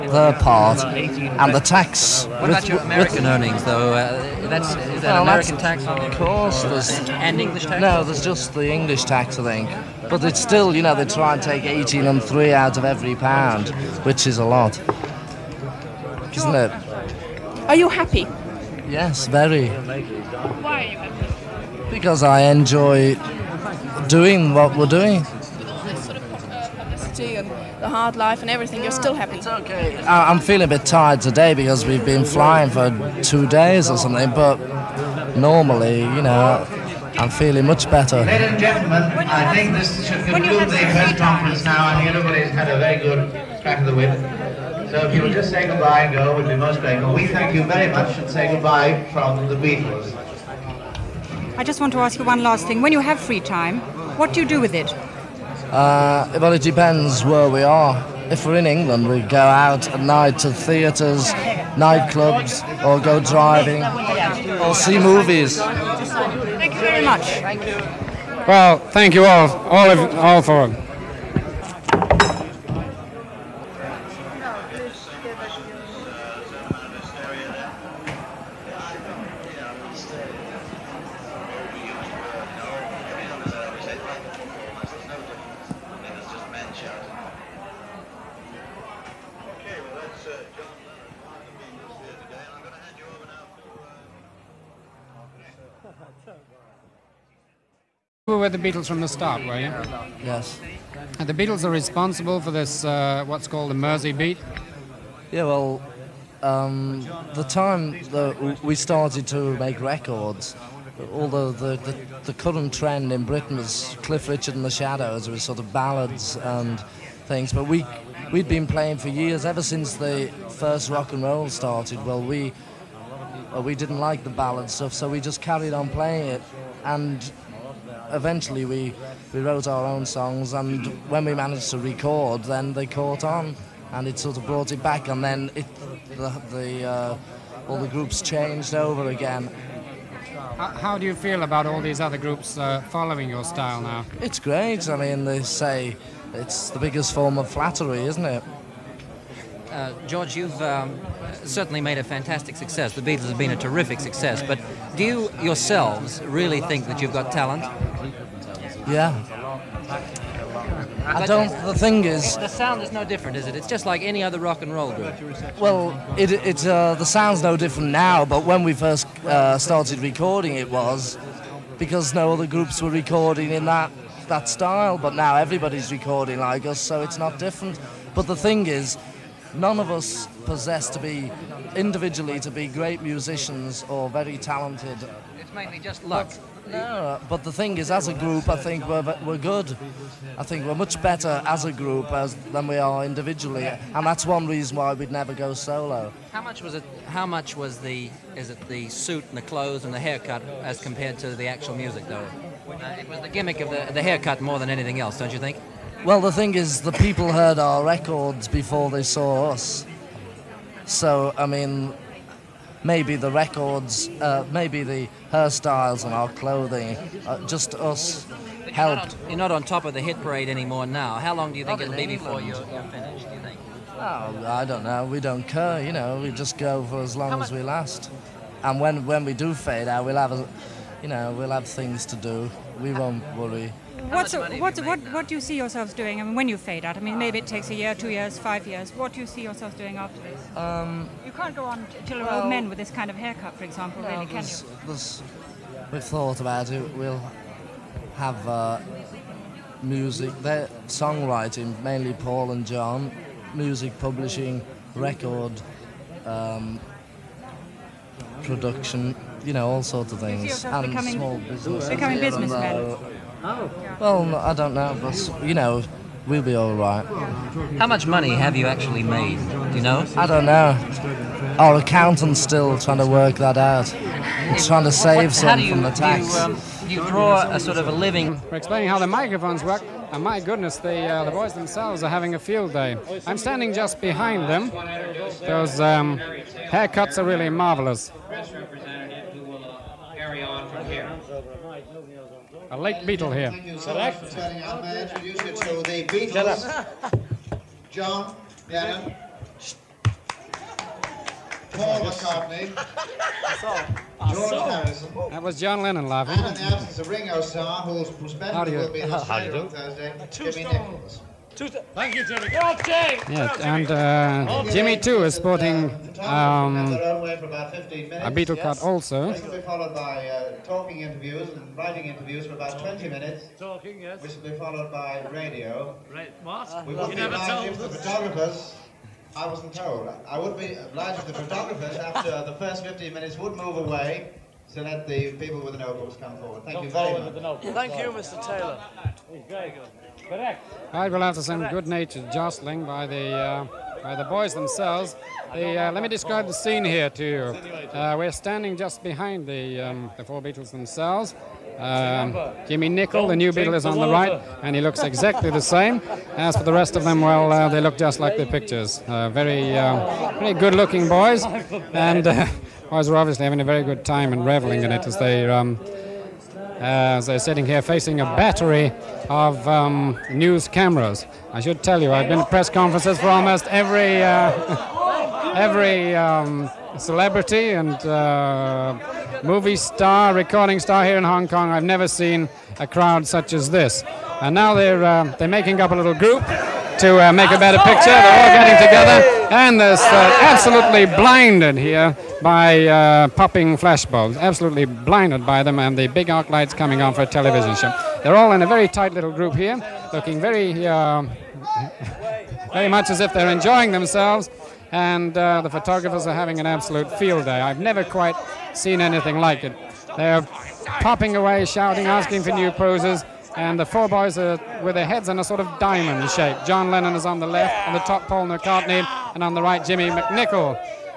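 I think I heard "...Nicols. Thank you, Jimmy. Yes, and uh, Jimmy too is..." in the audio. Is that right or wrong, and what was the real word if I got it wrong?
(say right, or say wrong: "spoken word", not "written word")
right.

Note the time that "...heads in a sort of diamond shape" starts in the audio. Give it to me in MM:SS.
06:55.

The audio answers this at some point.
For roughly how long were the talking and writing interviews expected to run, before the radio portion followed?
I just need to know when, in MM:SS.
05:22.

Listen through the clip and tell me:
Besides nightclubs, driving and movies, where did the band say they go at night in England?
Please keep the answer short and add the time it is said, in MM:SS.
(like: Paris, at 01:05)
theatres, at 01:00.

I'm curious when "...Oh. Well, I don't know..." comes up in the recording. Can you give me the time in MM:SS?
04:23.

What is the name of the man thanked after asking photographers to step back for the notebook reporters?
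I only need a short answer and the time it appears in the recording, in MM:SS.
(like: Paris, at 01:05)
Mr. Taylor, at 05:38.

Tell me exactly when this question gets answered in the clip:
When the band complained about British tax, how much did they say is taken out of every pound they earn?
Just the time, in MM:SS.
00:11.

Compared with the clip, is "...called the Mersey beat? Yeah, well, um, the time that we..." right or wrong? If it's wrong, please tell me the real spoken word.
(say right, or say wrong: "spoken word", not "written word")
right.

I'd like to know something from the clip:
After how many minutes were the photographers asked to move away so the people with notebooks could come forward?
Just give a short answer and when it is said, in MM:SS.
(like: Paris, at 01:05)
15 minutes, at 05:32.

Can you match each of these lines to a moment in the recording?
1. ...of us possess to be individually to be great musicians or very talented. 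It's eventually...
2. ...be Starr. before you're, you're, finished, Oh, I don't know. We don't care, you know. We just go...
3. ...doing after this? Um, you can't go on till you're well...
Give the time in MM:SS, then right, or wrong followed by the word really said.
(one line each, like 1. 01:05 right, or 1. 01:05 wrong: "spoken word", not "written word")
1. 02:59 wrong: "mainly", not "eventually"
2. 03:41 wrong: "England", not "Starr"
3. 03:59 right.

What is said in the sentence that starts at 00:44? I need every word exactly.
So if you would just say goodbye and go, we'd be most grateful.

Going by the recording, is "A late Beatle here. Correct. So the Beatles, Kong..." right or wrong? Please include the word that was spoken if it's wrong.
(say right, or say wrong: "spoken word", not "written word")
wrong: "John", not "Kong".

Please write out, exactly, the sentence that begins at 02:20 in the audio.
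How do you feel about all these other groups uh, following your style now?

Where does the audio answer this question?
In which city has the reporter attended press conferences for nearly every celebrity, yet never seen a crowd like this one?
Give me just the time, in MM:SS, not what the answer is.
06:21.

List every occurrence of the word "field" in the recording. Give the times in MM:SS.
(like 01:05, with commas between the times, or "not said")
04:42, 06:47.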